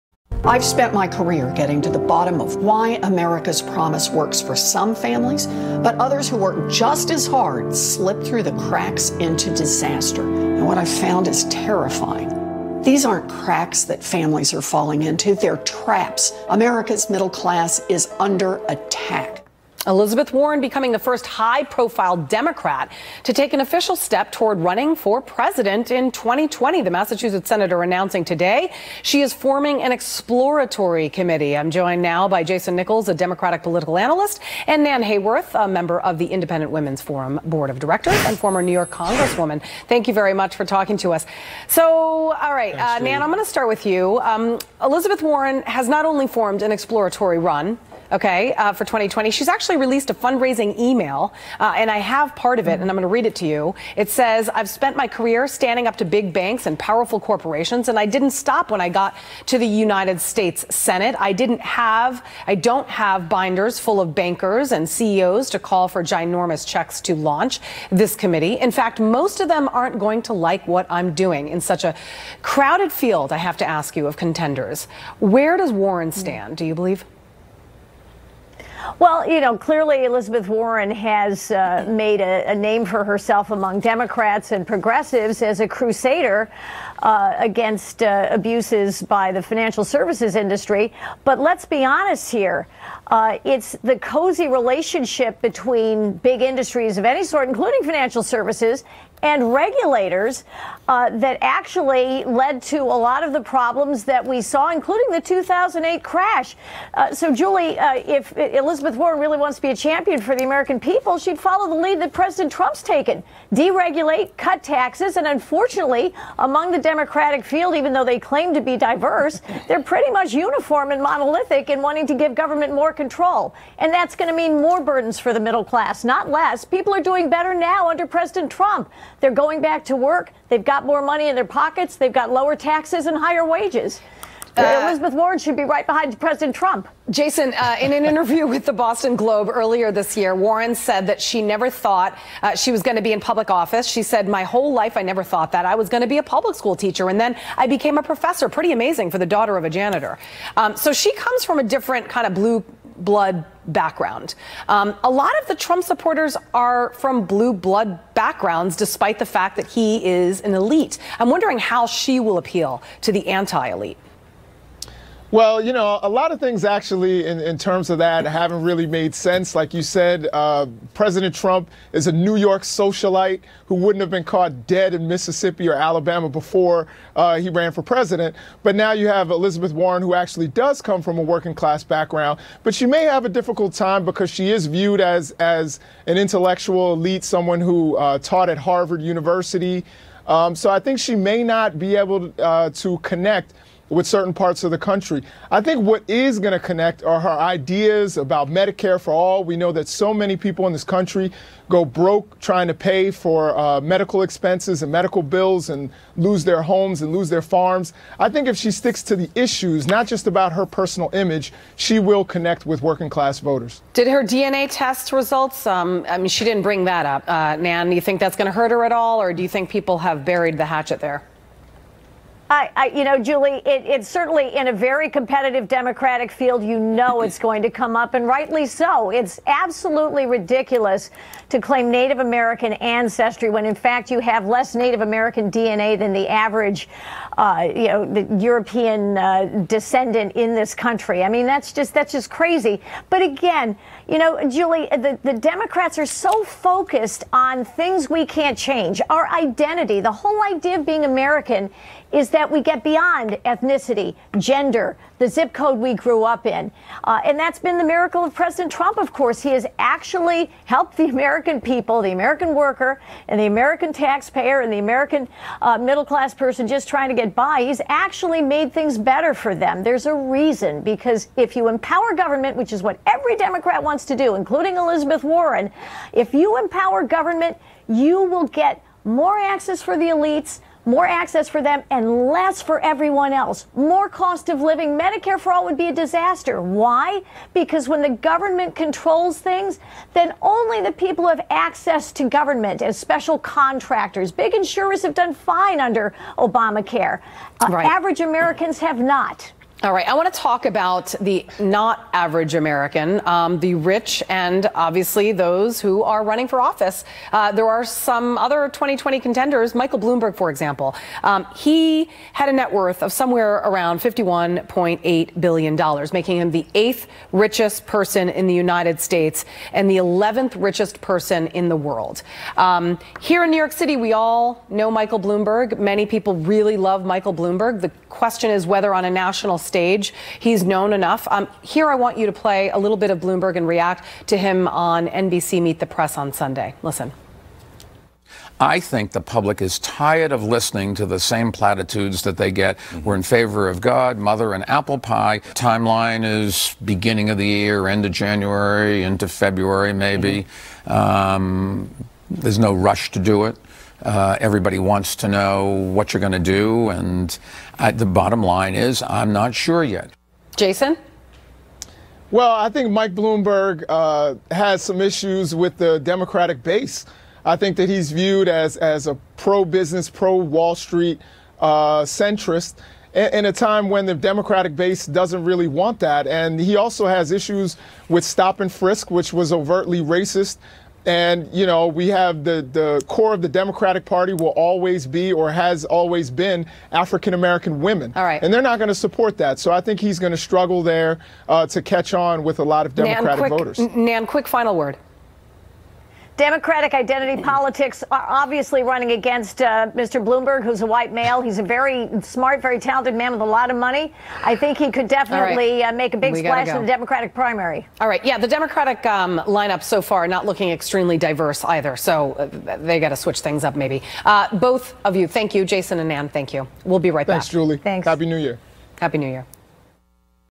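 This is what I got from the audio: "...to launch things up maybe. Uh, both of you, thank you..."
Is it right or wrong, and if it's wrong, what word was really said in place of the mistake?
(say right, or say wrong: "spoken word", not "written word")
wrong: "switch", not "launch".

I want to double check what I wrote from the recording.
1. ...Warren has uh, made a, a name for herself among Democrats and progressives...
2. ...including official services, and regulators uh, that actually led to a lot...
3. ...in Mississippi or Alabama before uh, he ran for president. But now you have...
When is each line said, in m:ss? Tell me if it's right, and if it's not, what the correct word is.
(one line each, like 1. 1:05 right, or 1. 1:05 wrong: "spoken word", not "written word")
1. 1:20 right
2. 1:37 wrong: "financial", not "official"
3. 2:54 right.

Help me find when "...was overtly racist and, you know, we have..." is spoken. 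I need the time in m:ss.
6:19.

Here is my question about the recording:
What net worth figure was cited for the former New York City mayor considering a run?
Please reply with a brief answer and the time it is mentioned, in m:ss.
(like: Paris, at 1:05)
$51.8 billion, at 5:14.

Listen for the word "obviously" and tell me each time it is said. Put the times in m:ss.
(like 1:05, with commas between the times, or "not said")
5:04, 6:38.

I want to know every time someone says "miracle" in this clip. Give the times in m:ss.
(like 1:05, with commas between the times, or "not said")
4:17.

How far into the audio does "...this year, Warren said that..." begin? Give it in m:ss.
2:19.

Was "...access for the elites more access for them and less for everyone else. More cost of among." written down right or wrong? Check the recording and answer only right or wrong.
wrong.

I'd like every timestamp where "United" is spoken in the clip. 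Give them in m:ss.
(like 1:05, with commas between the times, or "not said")
0:59, 5:18.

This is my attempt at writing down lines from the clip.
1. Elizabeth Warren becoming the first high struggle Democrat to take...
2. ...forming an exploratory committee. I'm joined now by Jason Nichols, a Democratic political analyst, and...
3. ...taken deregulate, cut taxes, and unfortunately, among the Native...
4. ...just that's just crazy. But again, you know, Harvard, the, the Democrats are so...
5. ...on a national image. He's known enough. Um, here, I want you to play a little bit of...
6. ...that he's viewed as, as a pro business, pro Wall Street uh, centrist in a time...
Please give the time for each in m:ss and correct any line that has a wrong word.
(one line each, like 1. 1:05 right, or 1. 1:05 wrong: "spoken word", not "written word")
1. 0:19 wrong: "profile", not "struggle"
2. 0:29 right
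3. 1:52 wrong: "Democratic", not "Native"
4. 4:01 wrong: "Julie", not "Harvard"
5. 5:28 wrong: "stage", not "image"
6. 6:07 right.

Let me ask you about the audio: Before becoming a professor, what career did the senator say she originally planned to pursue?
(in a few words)
Public school teacher.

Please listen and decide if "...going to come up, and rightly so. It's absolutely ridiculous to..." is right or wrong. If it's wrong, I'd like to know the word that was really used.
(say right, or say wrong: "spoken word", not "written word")
right.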